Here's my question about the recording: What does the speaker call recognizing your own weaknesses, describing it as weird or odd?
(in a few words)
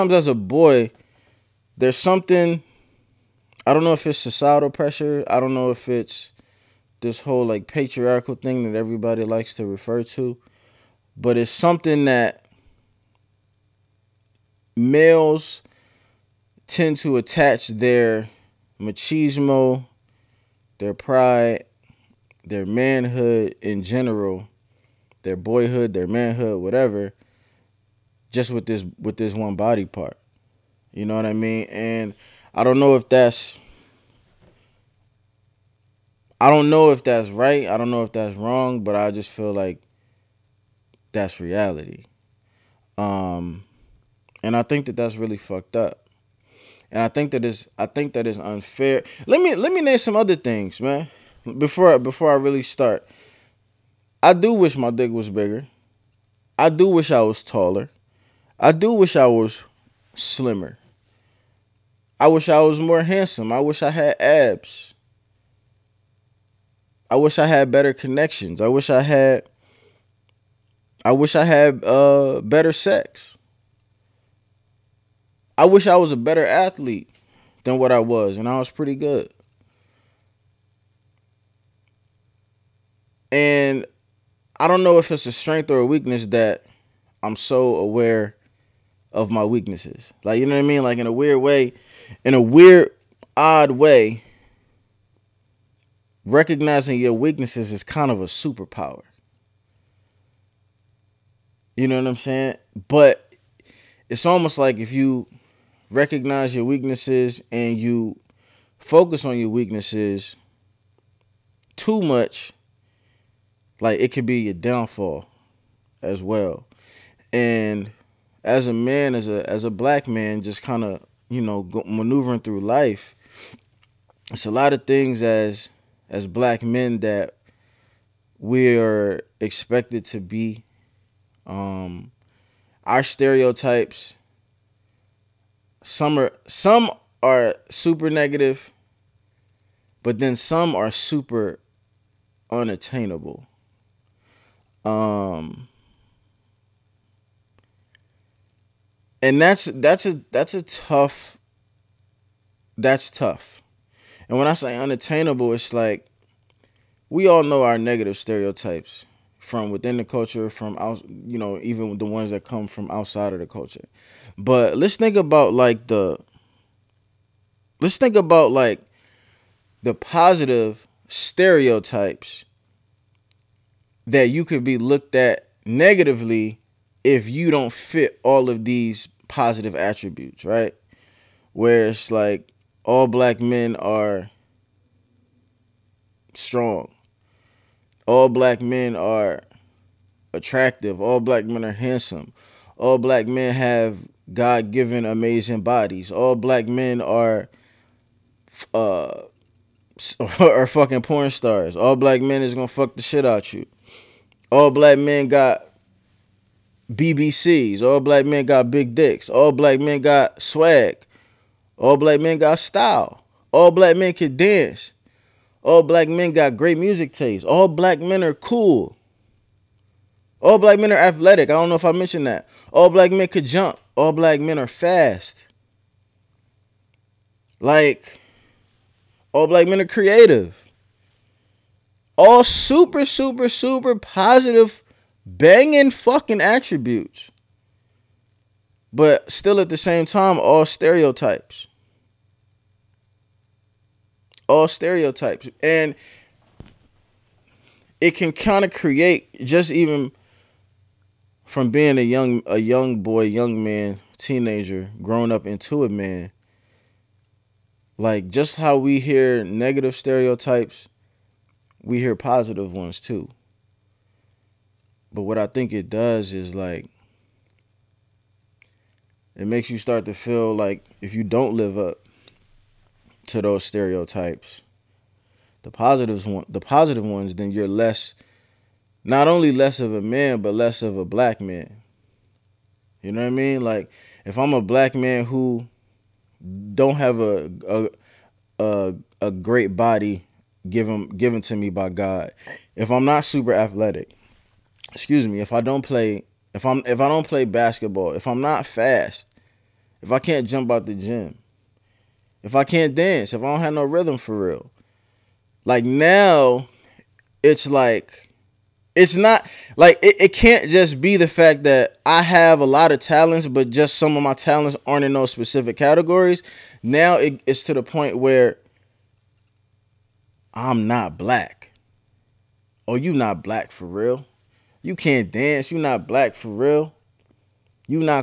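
A superpower.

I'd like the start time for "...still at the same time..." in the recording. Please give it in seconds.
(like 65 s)
239 s.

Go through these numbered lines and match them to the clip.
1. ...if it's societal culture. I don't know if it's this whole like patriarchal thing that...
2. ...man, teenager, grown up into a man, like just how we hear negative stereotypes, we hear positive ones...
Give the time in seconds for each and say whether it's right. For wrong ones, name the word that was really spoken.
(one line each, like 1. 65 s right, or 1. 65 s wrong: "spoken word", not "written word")
1. 3 s wrong: "pressure", not "culture"
2. 253 s right.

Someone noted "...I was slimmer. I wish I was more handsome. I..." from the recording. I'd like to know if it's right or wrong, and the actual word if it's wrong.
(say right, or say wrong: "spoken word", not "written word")
right.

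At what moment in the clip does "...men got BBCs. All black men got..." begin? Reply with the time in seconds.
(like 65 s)
204 s.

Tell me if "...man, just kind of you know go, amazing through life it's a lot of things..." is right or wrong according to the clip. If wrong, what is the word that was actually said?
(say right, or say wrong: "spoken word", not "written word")
wrong: "maneuvering", not "amazing".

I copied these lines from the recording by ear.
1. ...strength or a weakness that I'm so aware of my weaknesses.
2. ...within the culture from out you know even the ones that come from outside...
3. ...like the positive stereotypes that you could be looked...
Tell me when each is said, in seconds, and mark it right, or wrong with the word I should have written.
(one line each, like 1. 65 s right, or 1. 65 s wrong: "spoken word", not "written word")
1. 85 s right
2. 159 s right
3. 168 s right.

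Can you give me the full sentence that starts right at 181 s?
Where it's like all black men are strong.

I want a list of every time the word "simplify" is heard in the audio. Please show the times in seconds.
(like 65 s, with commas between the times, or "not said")
not said.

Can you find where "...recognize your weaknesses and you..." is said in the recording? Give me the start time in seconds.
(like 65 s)
105 s.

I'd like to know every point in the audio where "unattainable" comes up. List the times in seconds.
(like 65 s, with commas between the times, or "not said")
142 s, 154 s.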